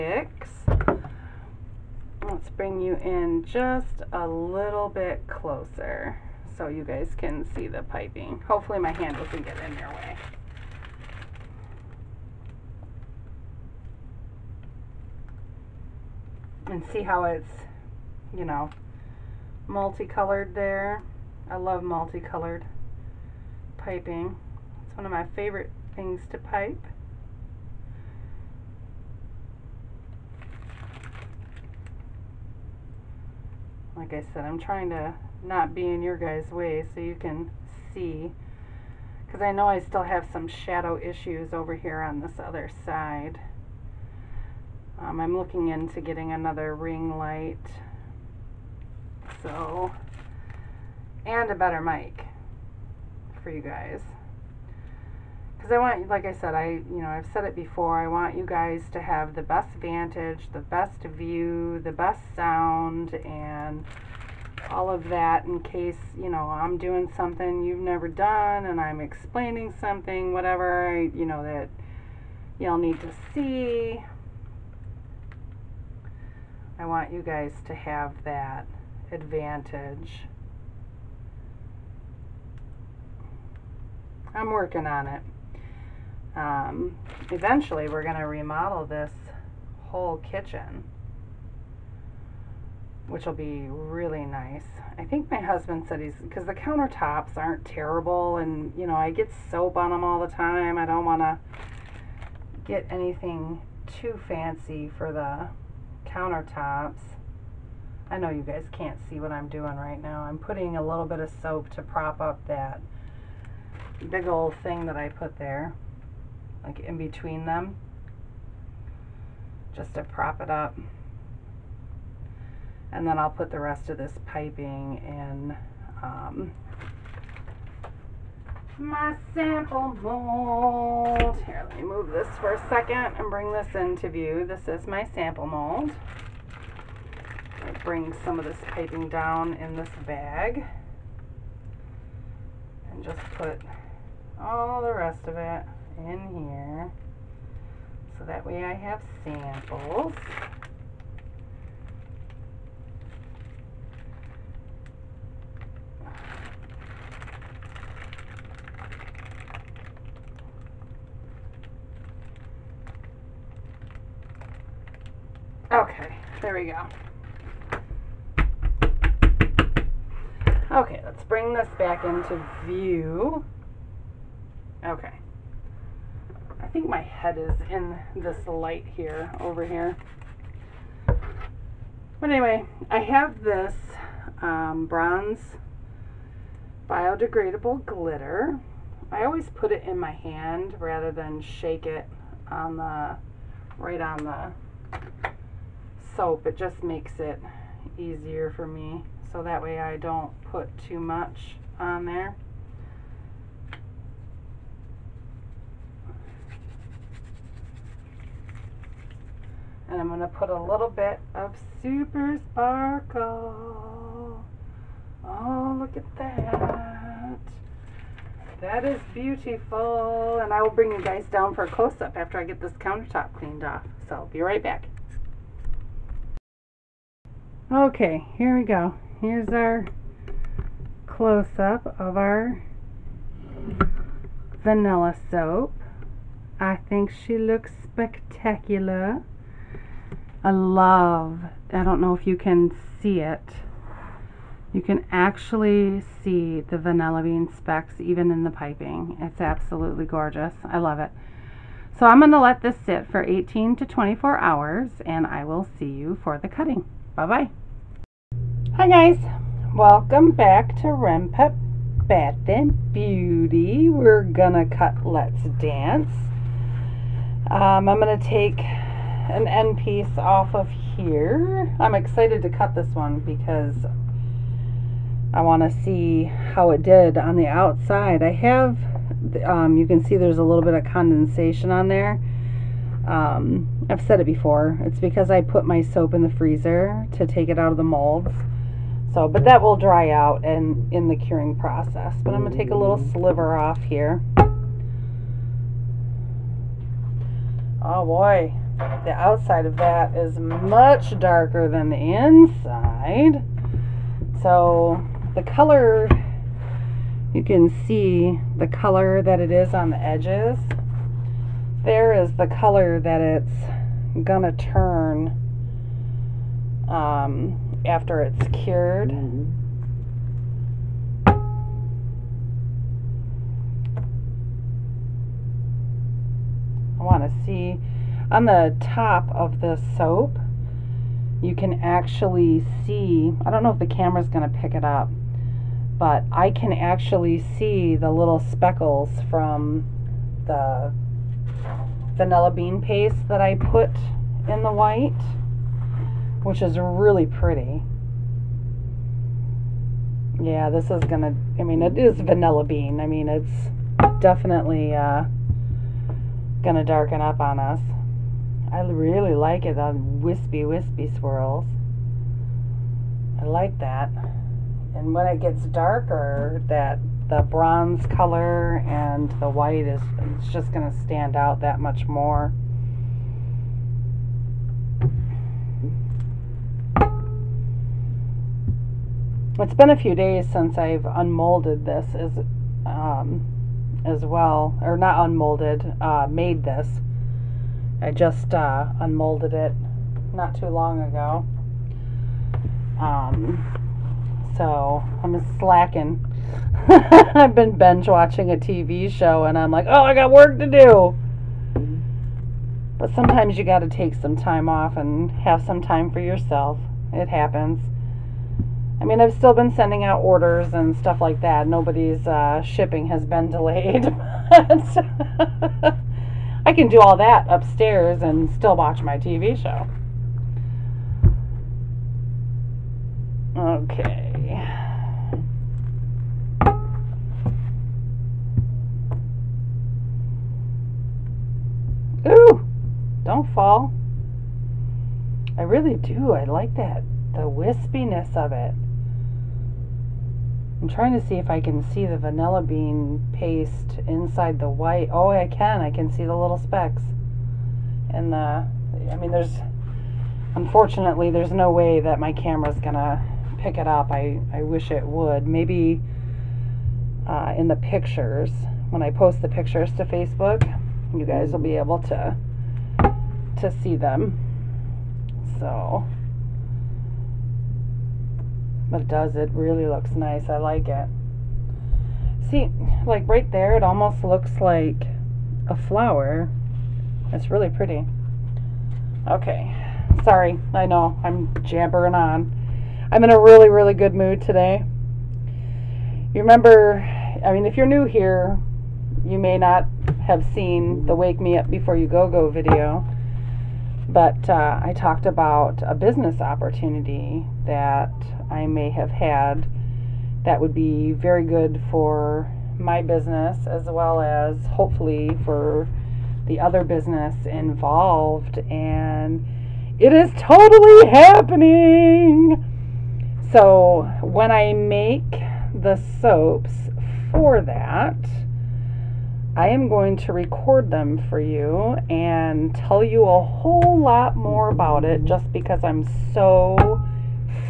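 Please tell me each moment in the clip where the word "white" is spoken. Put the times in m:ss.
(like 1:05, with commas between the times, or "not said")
5:44, 6:09, 7:24.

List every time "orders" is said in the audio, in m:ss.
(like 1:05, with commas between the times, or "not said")
6:50.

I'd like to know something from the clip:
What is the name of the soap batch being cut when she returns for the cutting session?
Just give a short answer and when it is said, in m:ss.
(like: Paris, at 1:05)
Let's Dance, at 4:25.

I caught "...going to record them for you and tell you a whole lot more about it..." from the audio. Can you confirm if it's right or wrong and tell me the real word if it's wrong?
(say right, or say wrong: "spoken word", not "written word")
right.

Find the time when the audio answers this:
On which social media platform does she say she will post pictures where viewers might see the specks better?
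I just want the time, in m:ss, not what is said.
7:40.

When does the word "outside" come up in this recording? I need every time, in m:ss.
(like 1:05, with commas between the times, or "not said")
4:37, 4:59.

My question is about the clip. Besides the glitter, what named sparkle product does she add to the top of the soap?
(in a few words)
Super Sparkle.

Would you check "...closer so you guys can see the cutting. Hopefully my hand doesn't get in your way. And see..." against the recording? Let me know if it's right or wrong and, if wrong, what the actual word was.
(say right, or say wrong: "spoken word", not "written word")
wrong: "piping", not "cutting".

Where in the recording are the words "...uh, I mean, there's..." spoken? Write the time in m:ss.
7:28.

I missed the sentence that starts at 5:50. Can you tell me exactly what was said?
Yeah, this is gonna, I mean, it is vanilla bean.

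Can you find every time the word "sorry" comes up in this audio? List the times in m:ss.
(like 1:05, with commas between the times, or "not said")
8:00.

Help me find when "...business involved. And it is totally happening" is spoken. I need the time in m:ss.
8:26.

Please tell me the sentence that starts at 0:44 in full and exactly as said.
Um, I'm looking into getting another ring light.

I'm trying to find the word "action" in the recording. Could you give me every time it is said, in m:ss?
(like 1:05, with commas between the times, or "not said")
not said.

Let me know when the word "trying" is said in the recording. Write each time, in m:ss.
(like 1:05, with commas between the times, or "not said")
0:34, 7:20.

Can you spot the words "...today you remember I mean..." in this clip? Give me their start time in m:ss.
8:04.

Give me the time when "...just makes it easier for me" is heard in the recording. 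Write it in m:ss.
3:16.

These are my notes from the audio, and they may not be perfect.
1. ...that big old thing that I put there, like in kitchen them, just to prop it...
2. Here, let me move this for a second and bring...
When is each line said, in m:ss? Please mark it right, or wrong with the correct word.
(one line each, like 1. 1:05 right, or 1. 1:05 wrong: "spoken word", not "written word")
1. 1:52 wrong: "between", not "kitchen"
2. 2:11 right.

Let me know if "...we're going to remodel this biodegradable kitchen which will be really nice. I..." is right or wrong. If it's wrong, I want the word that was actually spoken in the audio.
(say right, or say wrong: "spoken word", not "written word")
wrong: "whole", not "biodegradable".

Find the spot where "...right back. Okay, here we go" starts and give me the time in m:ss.
3:44.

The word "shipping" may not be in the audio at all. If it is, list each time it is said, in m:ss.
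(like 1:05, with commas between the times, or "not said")
6:52.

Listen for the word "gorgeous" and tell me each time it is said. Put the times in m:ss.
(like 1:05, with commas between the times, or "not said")
4:10.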